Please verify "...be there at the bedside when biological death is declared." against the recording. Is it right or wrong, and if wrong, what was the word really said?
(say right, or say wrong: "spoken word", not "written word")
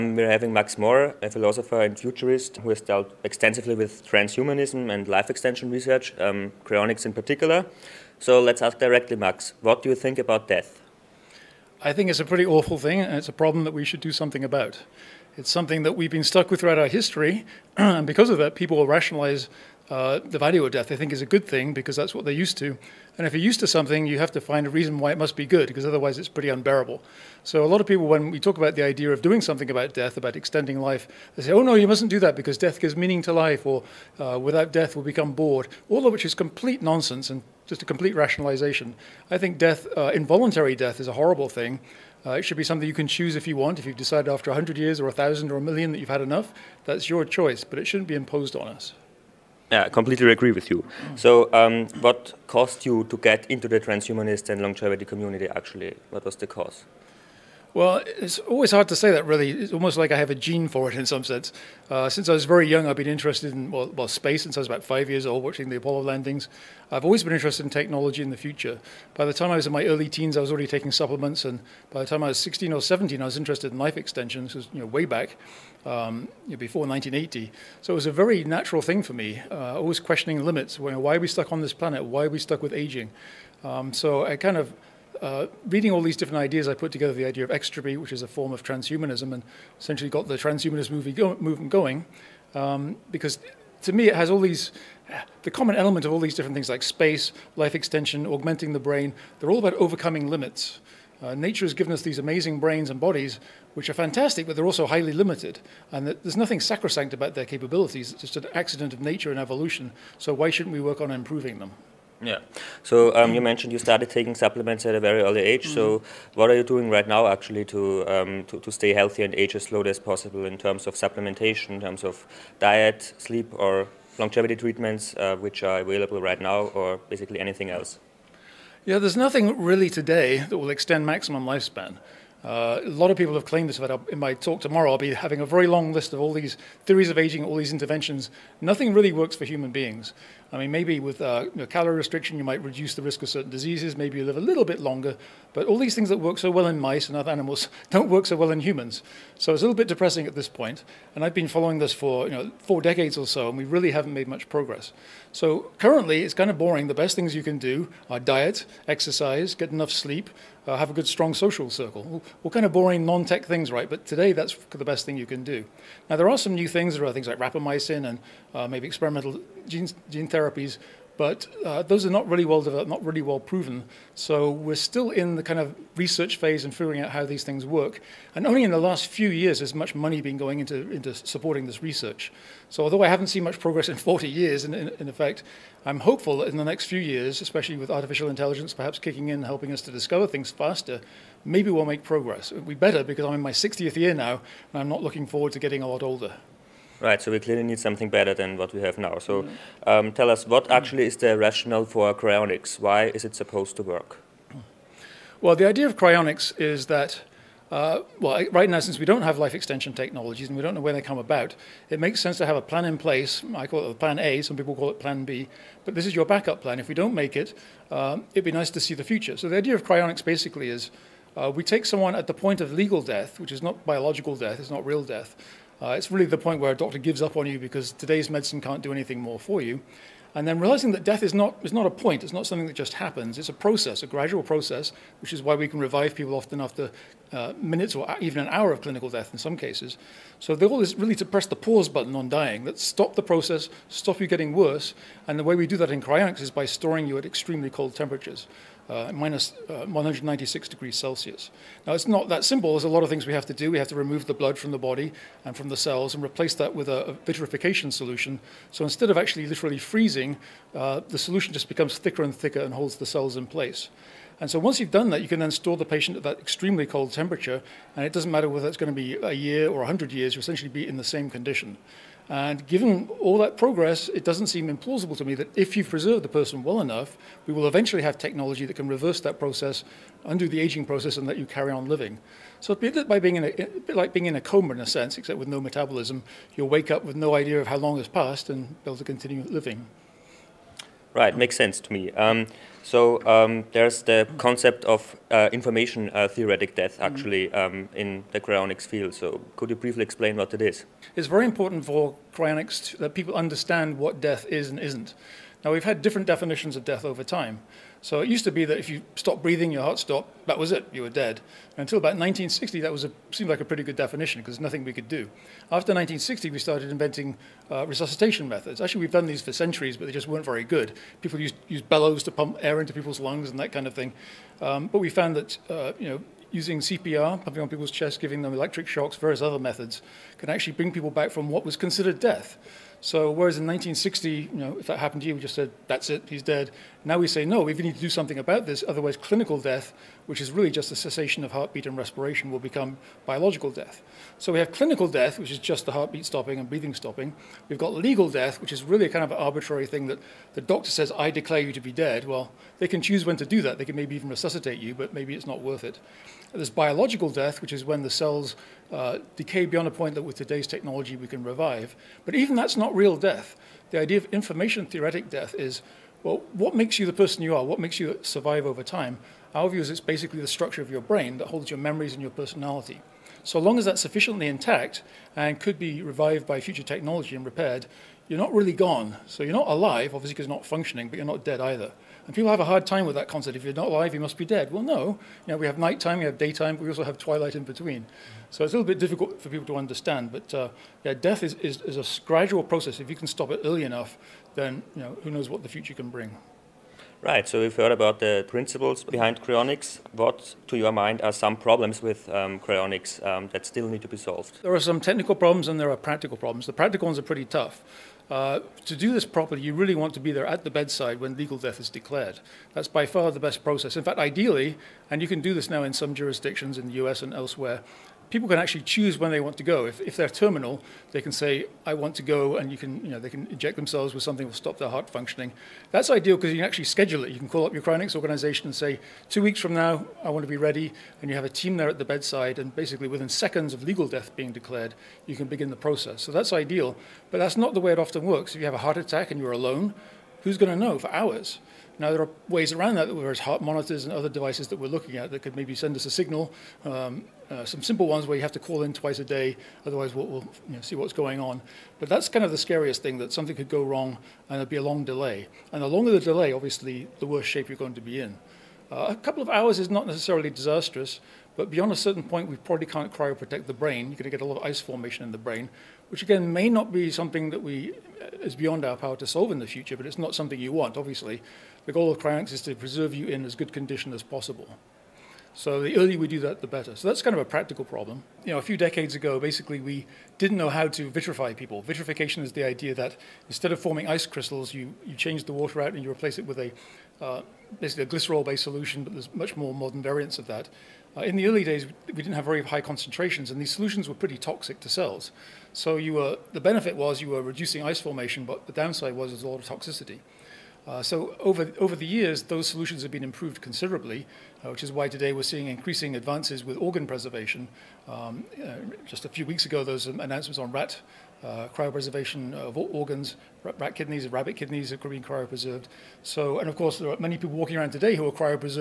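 wrong: "legal", not "biological".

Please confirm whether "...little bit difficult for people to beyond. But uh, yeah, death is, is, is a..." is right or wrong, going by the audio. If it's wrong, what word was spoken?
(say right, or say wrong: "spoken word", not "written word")
wrong: "understand", not "beyond".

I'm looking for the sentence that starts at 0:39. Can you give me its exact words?
I think death, uh, involuntary death, is a horrible thing.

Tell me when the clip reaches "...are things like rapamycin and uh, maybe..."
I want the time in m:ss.
2:47.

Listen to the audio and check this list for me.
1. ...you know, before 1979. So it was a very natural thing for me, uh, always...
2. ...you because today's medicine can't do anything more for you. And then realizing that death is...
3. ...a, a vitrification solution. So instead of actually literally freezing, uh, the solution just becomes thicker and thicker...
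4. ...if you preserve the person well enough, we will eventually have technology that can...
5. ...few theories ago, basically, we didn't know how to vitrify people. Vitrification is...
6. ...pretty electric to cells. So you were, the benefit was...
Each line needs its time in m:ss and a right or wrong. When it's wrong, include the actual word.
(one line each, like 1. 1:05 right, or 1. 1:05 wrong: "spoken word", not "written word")
1. 1:16 wrong: "1980", not "1979"
2. 3:47 right
3. 4:16 right
4. 4:35 right
5. 7:58 wrong: "decades", not "theories"
6. 8:14 wrong: "toxic", not "electric".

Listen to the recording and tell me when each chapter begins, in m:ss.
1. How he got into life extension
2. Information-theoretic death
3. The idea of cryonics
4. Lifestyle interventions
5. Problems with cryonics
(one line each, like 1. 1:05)
1. 0:49
2. 4:50
3. 3:16
4. 1:51
5. 6:36.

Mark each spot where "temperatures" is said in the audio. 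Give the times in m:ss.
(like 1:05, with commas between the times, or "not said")
4:07, 4:27.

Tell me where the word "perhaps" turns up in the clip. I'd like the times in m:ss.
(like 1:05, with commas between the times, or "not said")
3:08.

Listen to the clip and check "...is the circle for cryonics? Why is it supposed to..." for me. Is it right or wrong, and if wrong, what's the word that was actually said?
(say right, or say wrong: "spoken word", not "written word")
wrong: "rationale", not "circle".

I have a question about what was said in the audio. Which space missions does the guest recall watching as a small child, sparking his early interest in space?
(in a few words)
Apollo landings.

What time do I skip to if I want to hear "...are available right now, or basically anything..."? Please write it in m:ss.
2:05.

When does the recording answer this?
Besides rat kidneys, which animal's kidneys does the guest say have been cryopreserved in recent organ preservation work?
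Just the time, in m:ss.
8:34.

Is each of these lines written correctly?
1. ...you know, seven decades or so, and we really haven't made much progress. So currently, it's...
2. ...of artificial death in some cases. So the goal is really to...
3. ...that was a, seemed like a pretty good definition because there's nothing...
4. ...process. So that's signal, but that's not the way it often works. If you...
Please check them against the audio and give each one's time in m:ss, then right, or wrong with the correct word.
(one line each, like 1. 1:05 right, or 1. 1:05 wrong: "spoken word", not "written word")
1. 2:32 wrong: "four", not "seven"
2. 3:58 wrong: "clinical", not "artificial"
3. 5:12 right
4. 7:15 wrong: "ideal", not "signal".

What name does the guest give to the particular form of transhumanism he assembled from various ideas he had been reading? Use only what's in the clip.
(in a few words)
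extropy.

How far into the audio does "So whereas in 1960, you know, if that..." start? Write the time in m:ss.
5:33.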